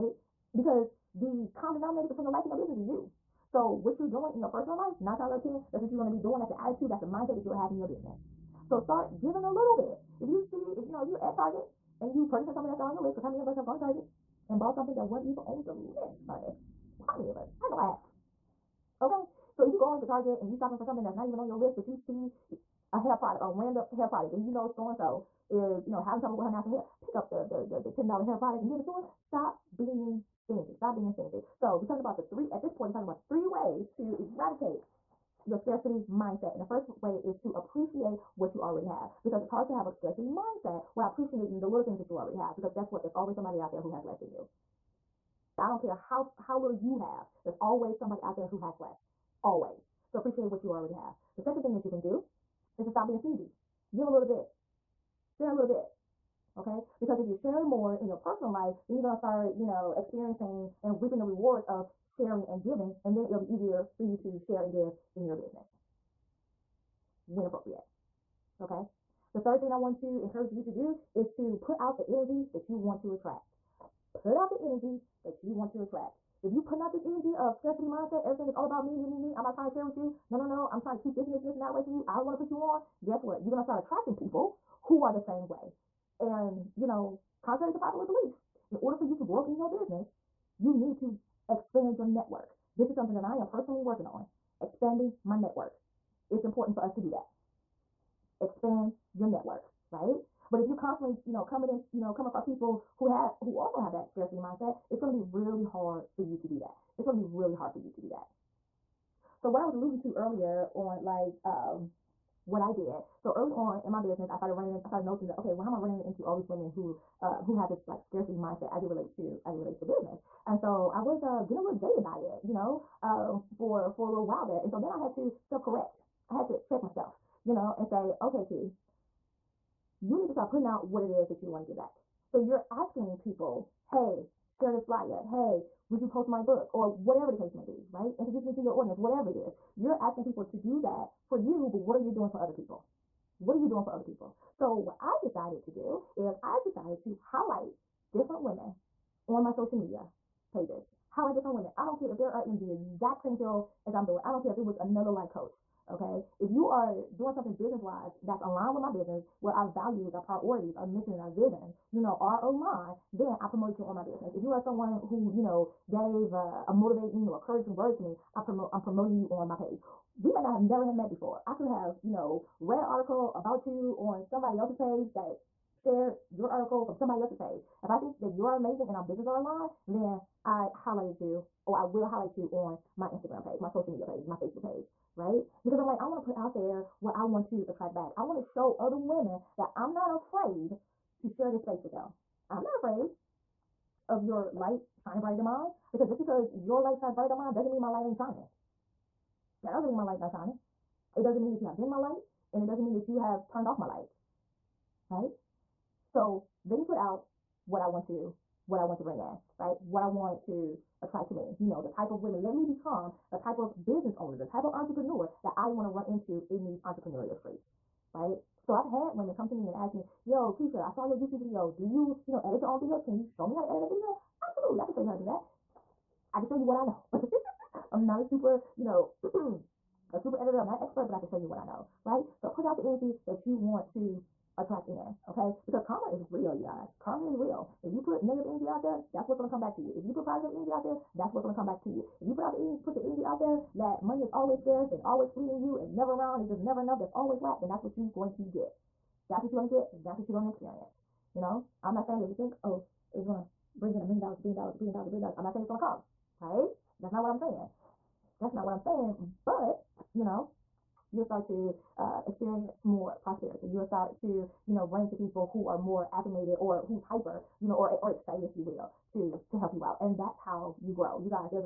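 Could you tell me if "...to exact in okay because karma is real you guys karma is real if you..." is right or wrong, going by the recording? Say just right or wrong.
wrong.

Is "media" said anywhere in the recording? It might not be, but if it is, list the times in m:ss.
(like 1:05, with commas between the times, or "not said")
2:29, 3:03.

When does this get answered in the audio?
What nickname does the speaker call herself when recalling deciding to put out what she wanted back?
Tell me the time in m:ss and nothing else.
2:08.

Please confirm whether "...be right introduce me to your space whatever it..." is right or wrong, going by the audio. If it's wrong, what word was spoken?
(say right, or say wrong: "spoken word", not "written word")
wrong: "audience", not "space".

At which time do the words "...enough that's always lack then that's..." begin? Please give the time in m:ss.
4:06.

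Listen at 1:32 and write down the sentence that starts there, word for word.
This is something that I am personally working on, expanding my network.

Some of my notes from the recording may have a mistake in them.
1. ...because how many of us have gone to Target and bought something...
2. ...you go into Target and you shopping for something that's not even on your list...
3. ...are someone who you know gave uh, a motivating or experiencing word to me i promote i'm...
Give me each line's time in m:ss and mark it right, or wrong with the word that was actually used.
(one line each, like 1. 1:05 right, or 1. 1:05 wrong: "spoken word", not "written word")
1. 0:13 right
2. 0:19 right
3. 2:44 wrong: "encouraging", not "experiencing".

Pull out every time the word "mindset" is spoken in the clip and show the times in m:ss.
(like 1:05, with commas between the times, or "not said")
0:07, 0:36, 0:40, 1:17, 1:44, 1:58.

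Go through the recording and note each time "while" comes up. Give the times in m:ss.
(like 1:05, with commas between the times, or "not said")
0:40, 2:04.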